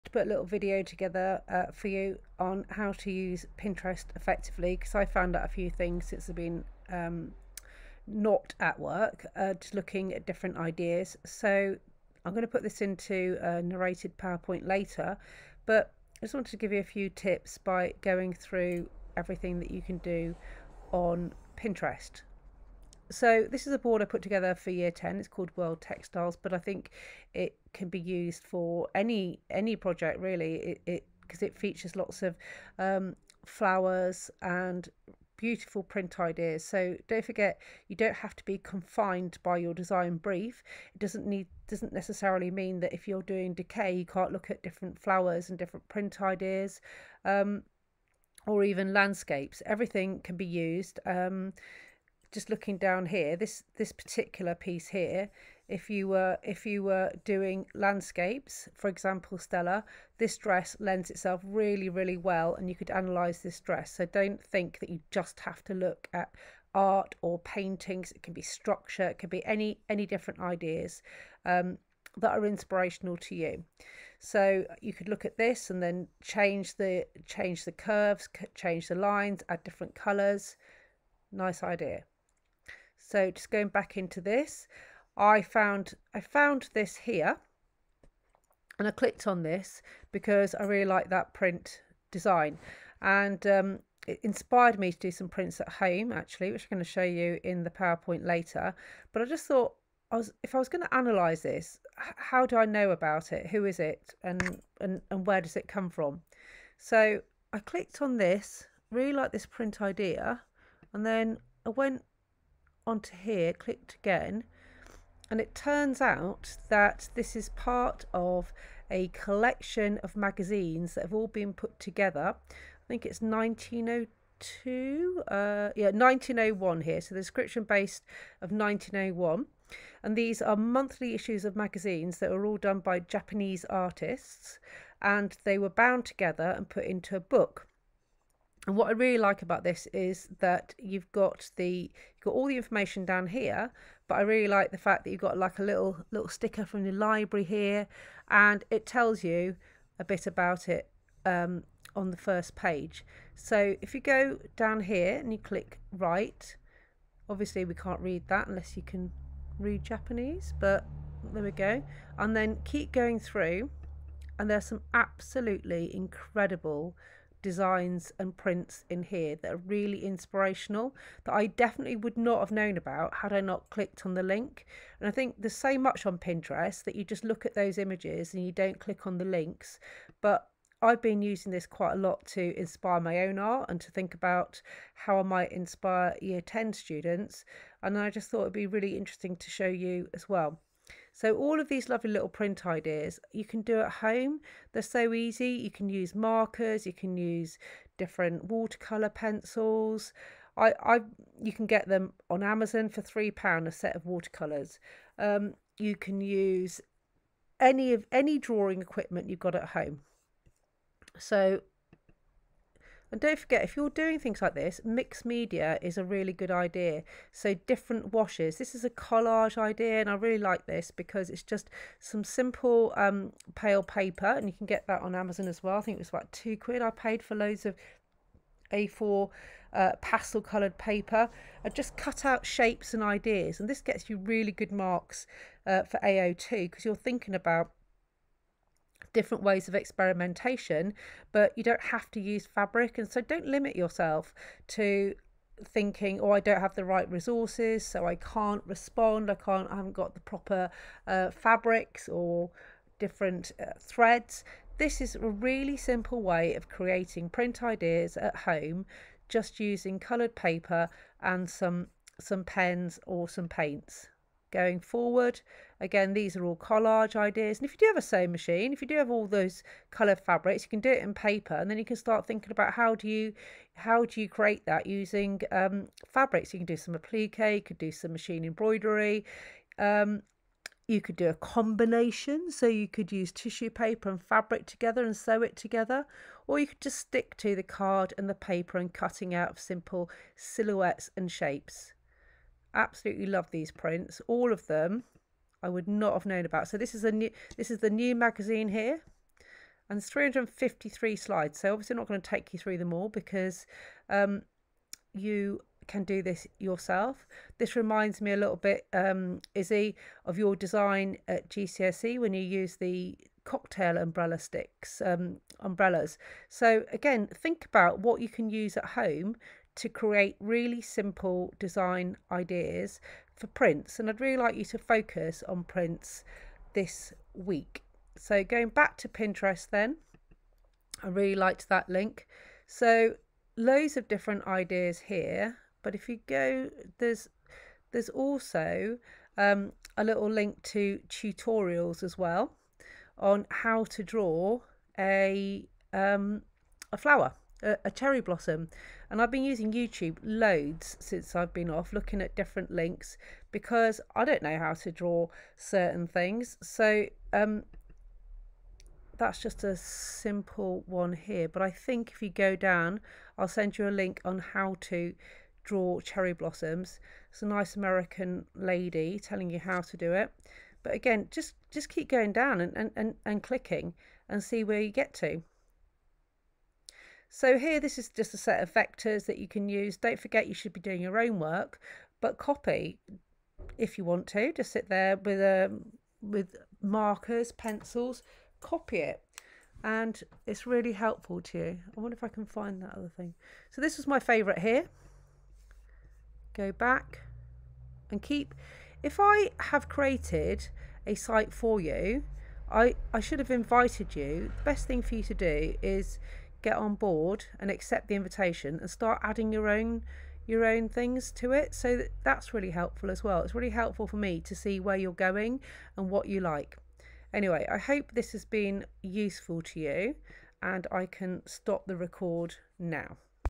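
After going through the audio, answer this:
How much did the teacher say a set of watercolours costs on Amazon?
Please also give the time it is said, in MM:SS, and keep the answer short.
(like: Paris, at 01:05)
3 pounds, at 03:23.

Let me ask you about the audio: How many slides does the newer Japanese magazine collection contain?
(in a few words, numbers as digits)
353.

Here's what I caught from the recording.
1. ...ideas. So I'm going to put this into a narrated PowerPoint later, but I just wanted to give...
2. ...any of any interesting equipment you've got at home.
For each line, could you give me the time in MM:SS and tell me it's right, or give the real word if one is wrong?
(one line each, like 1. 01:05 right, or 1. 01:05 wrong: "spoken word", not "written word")
1. 00:10 right
2. 03:27 wrong: "drawing", not "interesting".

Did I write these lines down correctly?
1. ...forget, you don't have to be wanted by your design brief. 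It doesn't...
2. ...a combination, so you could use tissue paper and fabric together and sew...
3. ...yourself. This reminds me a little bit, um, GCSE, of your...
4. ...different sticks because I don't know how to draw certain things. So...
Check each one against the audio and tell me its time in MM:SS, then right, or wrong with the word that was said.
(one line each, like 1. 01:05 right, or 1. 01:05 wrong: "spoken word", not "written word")
1. 00:37 wrong: "confined", not "wanted"
2. 04:41 right
3. 05:06 wrong: "Izzy", not "GCSE"
4. 05:52 wrong: "links", not "sticks".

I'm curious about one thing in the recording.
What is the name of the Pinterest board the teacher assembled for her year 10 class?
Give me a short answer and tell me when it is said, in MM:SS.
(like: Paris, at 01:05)
World Textiles, at 00:25.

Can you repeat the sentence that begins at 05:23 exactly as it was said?
And I'd really like you to focus on prints this week.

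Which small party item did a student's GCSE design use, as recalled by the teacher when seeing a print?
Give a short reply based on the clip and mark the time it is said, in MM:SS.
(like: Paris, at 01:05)
cocktail umbrella sticks, at 05:13.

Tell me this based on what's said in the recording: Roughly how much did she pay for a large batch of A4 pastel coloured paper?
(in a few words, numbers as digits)
2 pounds.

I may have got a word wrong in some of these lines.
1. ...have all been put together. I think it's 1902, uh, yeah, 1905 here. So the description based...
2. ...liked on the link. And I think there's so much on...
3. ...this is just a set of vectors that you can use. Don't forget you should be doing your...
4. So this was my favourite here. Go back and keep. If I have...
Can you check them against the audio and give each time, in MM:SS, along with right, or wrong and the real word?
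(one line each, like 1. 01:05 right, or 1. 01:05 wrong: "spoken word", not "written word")
1. 02:01 wrong: "1901", not "1905"
2. 02:53 wrong: "clicked", not "liked"
3. 06:17 right
4. 06:33 right.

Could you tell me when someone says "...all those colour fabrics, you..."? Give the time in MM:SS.
04:29.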